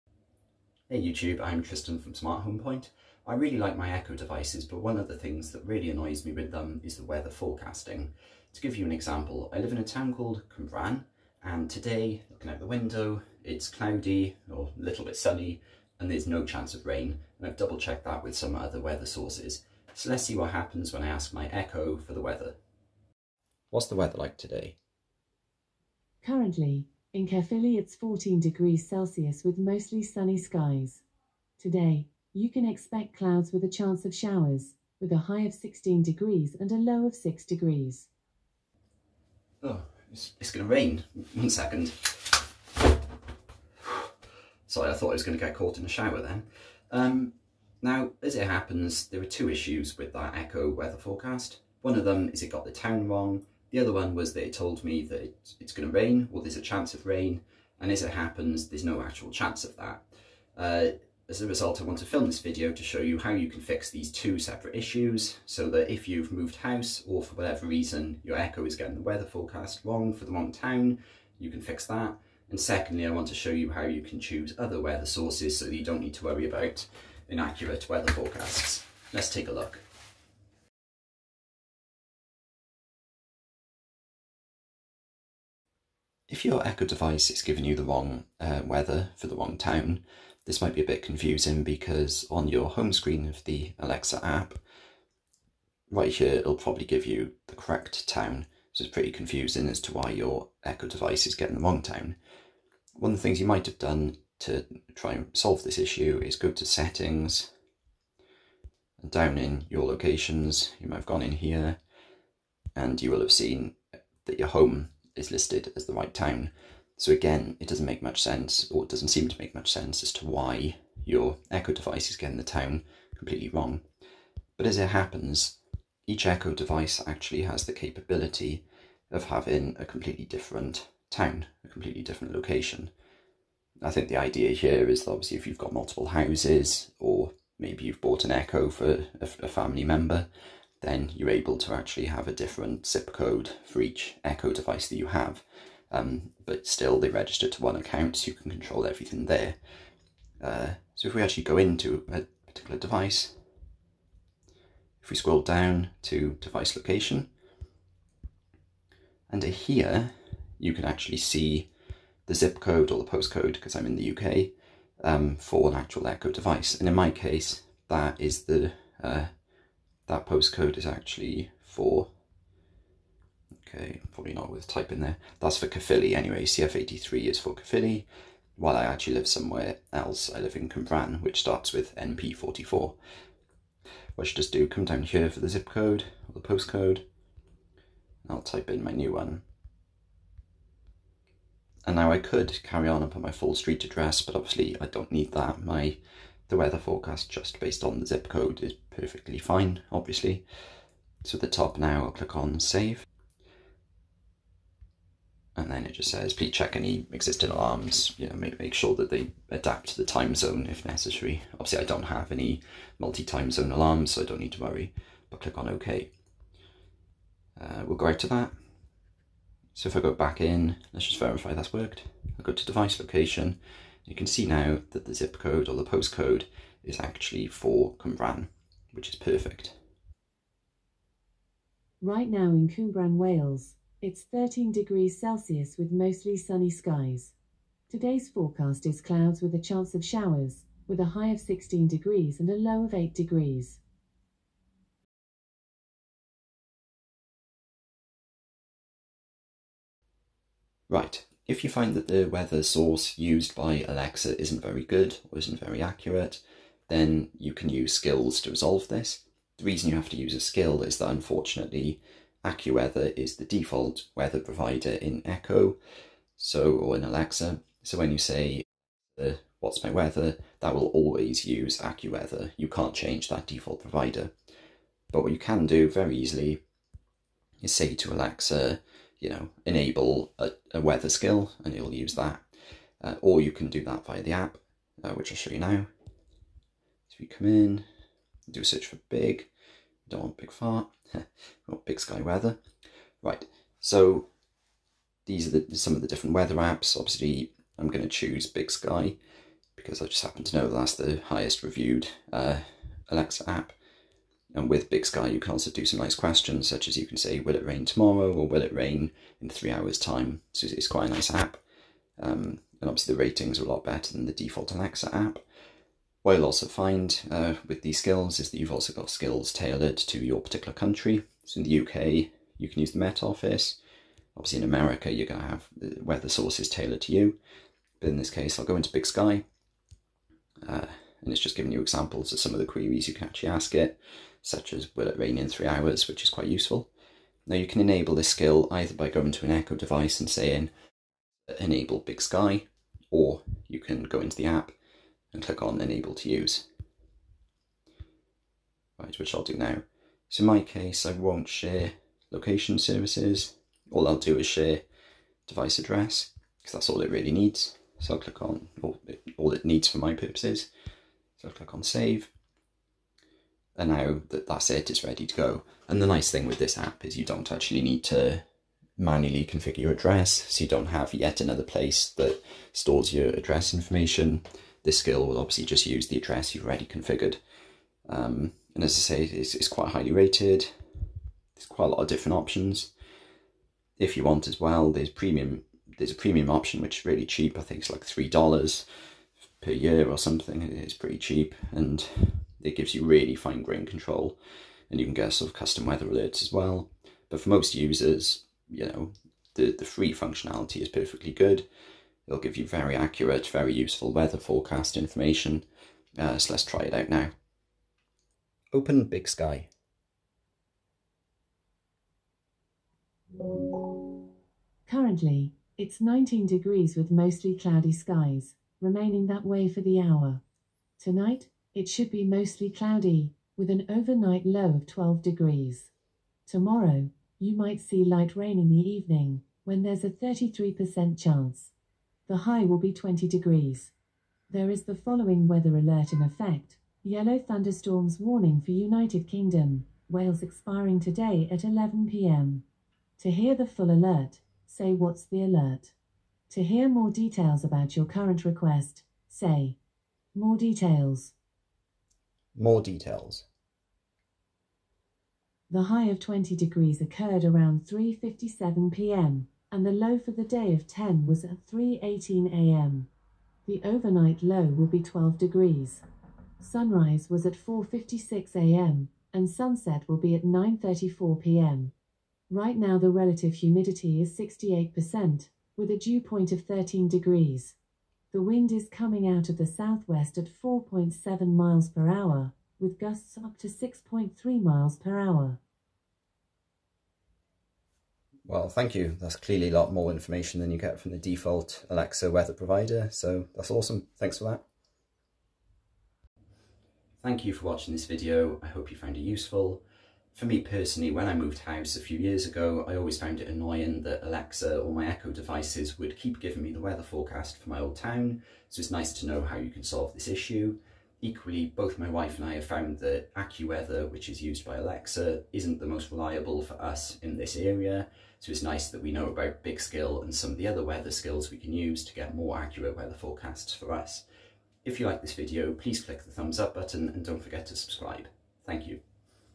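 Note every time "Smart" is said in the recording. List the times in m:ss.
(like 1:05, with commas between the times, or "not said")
0:02.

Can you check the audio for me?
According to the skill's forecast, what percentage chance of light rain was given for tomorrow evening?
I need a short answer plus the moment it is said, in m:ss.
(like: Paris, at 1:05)
33%, at 7:10.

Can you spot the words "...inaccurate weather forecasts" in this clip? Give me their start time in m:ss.
1:17.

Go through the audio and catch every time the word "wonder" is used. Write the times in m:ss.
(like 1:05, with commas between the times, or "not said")
not said.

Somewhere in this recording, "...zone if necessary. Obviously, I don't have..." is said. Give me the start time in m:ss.
3:30.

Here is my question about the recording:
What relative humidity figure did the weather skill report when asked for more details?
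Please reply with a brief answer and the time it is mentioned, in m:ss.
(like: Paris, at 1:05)
68%, at 7:54.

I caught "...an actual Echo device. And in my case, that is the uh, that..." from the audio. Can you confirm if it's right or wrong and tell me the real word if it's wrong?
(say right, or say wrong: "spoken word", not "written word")
right.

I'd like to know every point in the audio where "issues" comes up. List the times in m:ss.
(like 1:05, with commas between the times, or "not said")
0:49, 1:04, 1:45, 8:30.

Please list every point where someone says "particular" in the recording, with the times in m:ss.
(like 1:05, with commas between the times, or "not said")
2:32, 5:20.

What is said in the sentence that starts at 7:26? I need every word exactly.
To hear more details about your current request, say more details.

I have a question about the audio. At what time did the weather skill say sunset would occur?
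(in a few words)
9:34 p.m.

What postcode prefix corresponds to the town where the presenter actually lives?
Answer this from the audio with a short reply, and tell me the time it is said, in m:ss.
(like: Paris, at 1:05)
NP44, at 3:01.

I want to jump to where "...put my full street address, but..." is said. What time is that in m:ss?
3:13.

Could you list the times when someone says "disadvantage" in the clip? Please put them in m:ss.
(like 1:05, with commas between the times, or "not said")
not said.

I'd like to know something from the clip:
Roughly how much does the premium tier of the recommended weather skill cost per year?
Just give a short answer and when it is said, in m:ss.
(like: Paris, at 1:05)
3 dollars, at 6:28.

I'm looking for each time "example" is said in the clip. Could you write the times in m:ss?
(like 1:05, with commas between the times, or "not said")
0:08, 5:31.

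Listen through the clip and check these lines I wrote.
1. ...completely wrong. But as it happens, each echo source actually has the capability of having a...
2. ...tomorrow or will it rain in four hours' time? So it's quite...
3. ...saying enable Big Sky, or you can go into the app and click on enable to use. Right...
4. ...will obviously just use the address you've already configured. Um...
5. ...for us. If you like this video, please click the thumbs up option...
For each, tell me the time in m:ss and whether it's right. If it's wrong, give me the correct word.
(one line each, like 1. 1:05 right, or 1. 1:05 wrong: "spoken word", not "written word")
1. 2:03 wrong: "device", not "source"
2. 5:07 wrong: "three", not "four"
3. 5:40 right
4. 6:15 right
5. 8:43 wrong: "button", not "option".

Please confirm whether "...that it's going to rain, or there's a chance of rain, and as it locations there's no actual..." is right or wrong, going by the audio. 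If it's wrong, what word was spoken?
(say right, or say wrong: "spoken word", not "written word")
wrong: "happens", not "locations".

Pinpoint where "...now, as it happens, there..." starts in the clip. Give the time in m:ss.
0:47.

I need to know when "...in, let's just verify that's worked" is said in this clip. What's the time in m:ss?
3:40.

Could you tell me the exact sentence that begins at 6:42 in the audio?
It'll give you very accurate, very useful weather forecast information.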